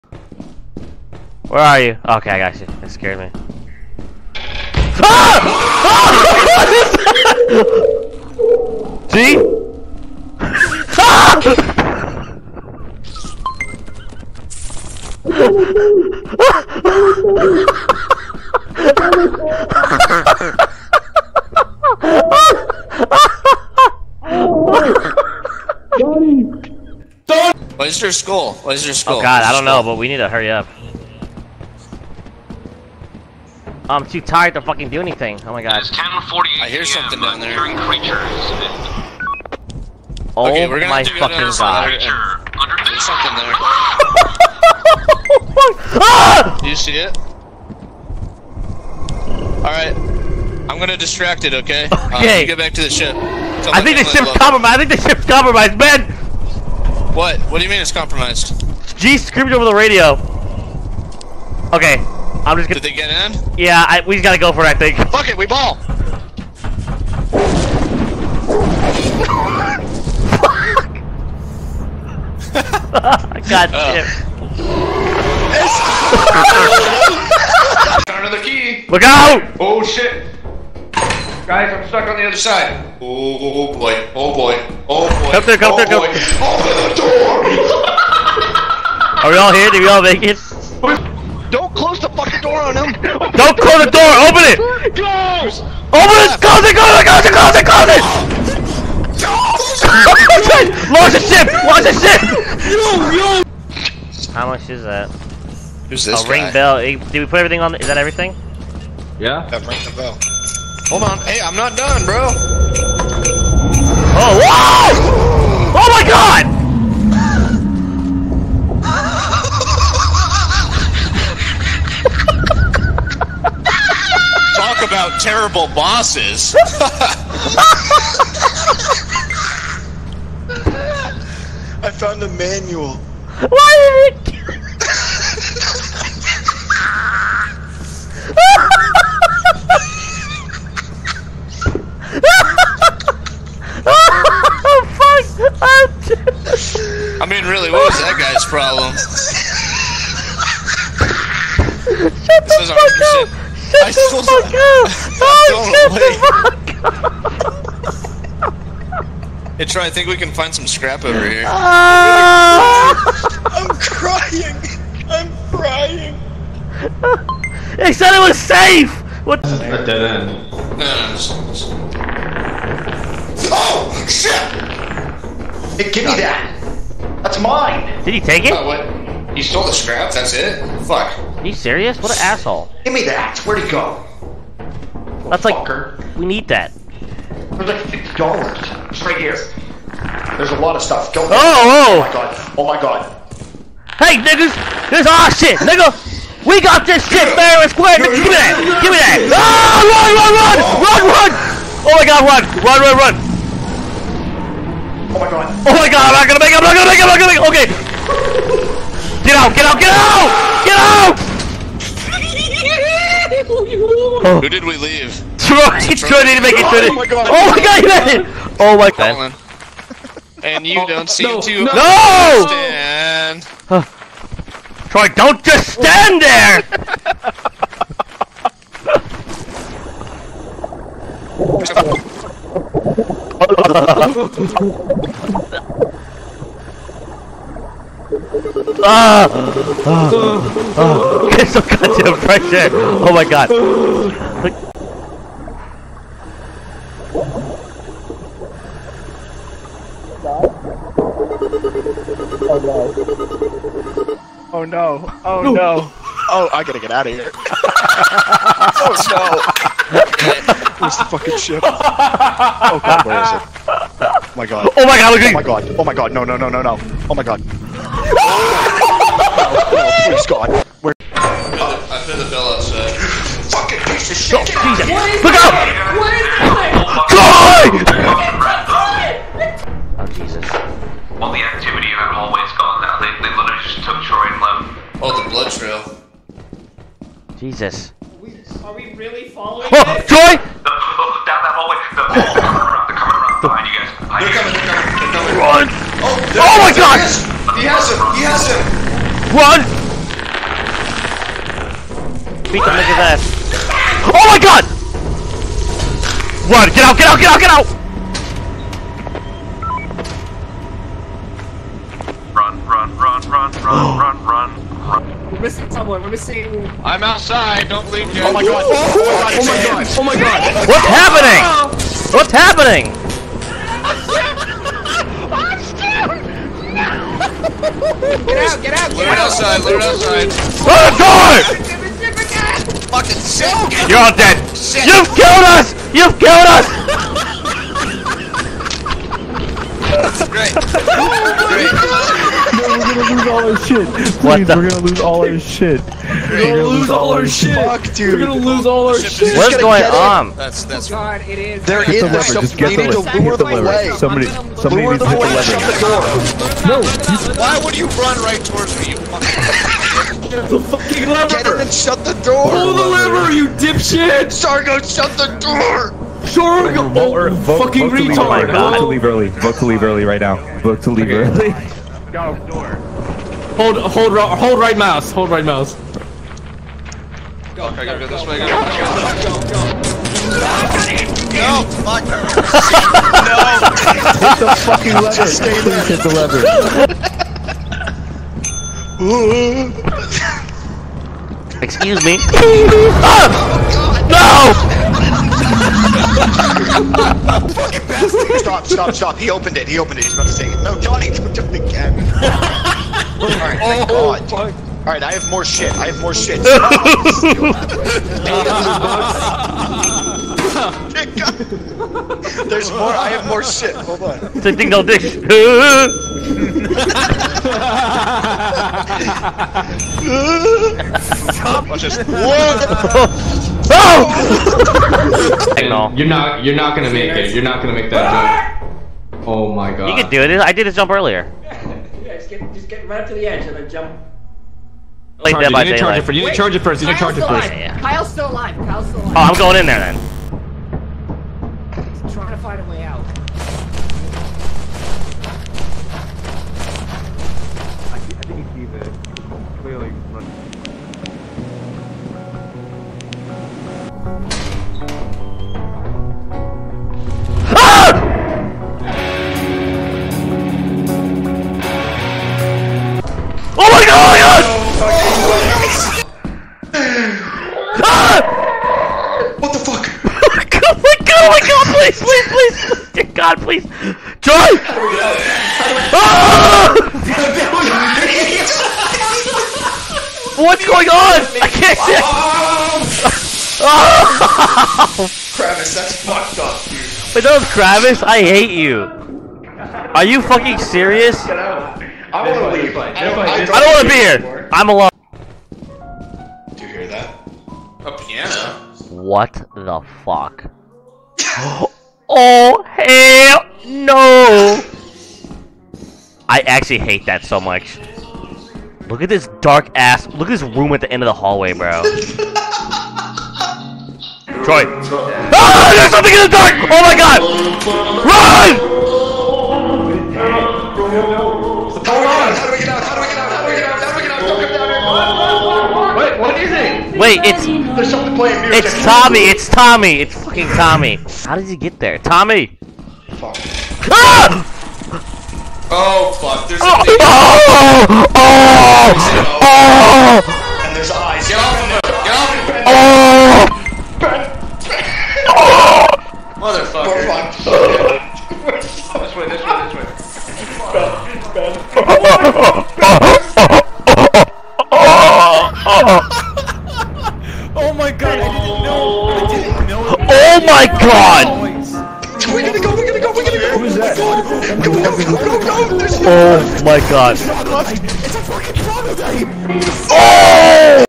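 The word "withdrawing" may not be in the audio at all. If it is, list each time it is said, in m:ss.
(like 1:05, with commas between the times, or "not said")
not said.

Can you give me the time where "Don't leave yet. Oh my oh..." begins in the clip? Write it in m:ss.
5:17.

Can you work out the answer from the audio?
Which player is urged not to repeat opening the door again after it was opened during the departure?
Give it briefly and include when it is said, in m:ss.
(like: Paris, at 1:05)
Johnny, at 6:40.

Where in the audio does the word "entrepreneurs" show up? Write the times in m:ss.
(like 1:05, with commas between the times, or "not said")
not said.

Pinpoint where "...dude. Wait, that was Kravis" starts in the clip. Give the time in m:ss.
8:06.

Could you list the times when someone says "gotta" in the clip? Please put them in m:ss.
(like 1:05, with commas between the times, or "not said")
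1:04, 4:16.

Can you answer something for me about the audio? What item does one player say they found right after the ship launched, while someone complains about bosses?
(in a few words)
A manual.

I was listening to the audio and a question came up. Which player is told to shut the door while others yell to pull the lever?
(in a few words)
Sargo.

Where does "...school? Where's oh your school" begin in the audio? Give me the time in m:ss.
0:28.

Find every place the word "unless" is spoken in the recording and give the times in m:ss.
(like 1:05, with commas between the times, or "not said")
not said.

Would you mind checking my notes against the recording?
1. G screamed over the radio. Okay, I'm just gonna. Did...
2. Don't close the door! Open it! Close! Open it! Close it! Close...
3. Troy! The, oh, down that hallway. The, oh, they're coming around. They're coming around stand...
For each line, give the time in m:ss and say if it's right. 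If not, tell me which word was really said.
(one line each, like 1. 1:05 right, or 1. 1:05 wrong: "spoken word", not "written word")
1. 0:58 right
2. 1:33 right
3. 4:50 wrong: "behind", not "stand".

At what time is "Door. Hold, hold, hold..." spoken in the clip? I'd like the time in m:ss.
6:12.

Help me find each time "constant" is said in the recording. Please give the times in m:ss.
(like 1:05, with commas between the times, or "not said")
not said.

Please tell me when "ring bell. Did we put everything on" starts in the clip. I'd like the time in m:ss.
1:46.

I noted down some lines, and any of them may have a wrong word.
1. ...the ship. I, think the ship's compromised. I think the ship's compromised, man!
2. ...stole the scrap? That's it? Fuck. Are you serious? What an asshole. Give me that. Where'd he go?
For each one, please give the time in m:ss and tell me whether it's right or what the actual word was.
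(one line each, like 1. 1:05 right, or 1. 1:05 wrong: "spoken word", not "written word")
1. 0:52 right
2. 2:59 right.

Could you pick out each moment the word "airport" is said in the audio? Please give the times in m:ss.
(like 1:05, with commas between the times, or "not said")
not said.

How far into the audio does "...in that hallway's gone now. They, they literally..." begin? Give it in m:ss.
4:41.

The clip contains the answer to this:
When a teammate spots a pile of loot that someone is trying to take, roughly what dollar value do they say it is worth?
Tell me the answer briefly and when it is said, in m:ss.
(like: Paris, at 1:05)
50 dollars, at 3:07.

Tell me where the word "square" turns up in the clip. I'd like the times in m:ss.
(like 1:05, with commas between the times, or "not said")
3:17.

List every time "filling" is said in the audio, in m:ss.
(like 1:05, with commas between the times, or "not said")
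not said.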